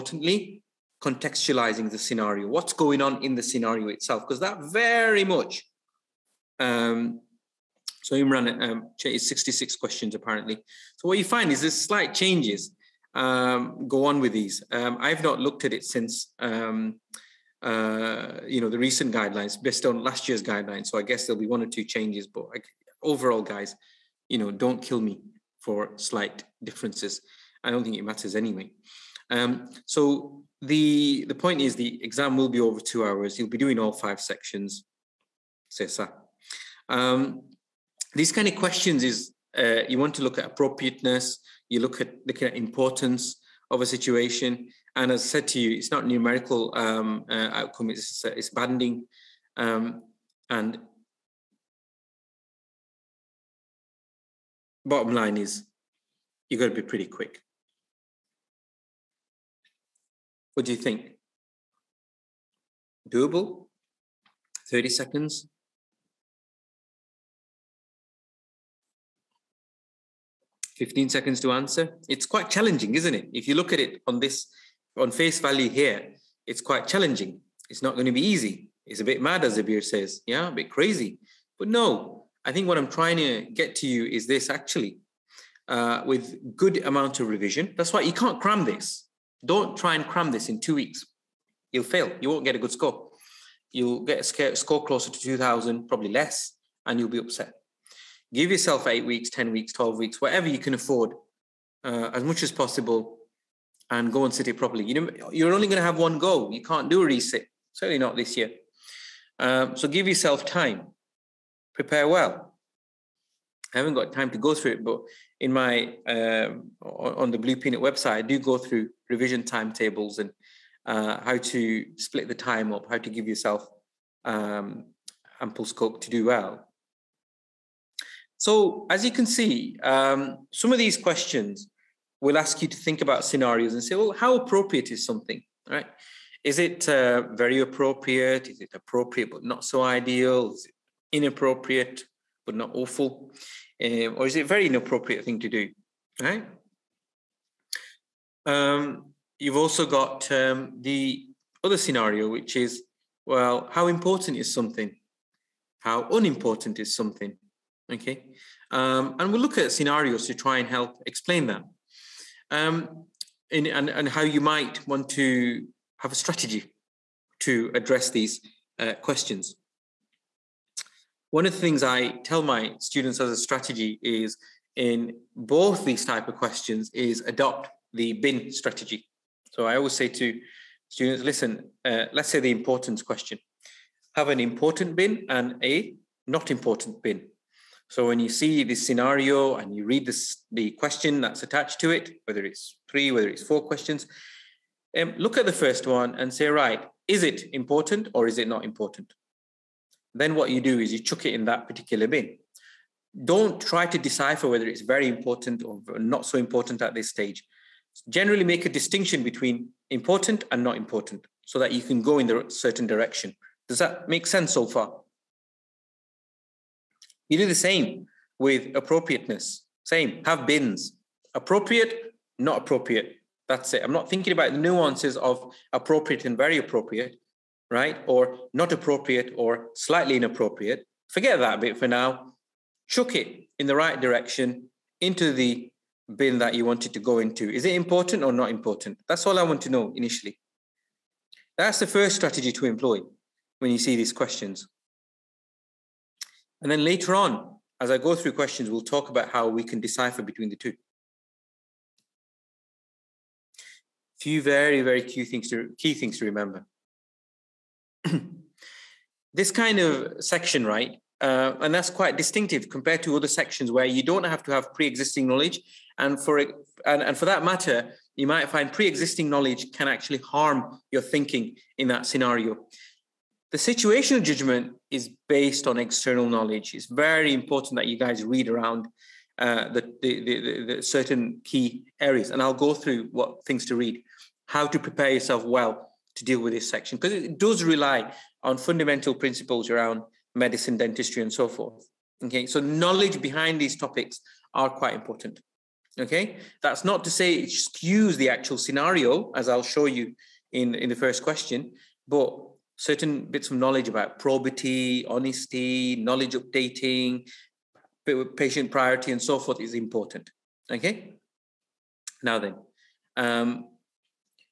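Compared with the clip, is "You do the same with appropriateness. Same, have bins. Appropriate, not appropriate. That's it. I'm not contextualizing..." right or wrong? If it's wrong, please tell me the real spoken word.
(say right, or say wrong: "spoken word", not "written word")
wrong: "thinking", not "contextualizing".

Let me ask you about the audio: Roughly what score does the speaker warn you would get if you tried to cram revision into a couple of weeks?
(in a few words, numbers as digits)
2000.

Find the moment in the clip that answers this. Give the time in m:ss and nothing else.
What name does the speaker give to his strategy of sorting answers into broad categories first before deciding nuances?
2:57.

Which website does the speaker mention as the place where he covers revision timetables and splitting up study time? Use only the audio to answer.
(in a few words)
Blue Peanut.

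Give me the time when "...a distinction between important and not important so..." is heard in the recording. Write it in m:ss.
3:28.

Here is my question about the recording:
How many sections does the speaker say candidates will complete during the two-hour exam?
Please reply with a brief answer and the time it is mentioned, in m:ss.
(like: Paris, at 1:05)
5, at 0:33.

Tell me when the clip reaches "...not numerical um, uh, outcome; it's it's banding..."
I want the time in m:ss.
0:45.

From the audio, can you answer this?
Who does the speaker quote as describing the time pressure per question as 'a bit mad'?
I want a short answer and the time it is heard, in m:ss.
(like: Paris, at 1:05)
Zabir, at 1:19.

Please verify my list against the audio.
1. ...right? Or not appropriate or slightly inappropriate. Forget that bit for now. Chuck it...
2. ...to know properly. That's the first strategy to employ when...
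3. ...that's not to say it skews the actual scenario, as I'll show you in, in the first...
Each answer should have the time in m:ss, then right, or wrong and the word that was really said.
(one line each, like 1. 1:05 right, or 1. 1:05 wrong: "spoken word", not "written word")
1. 3:47 right
2. 3:59 wrong: "initially", not "properly"
3. 4:56 right.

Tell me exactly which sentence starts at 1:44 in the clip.
You know, you're only going to have one go.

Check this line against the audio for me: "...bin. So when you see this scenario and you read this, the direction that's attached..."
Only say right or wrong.
wrong.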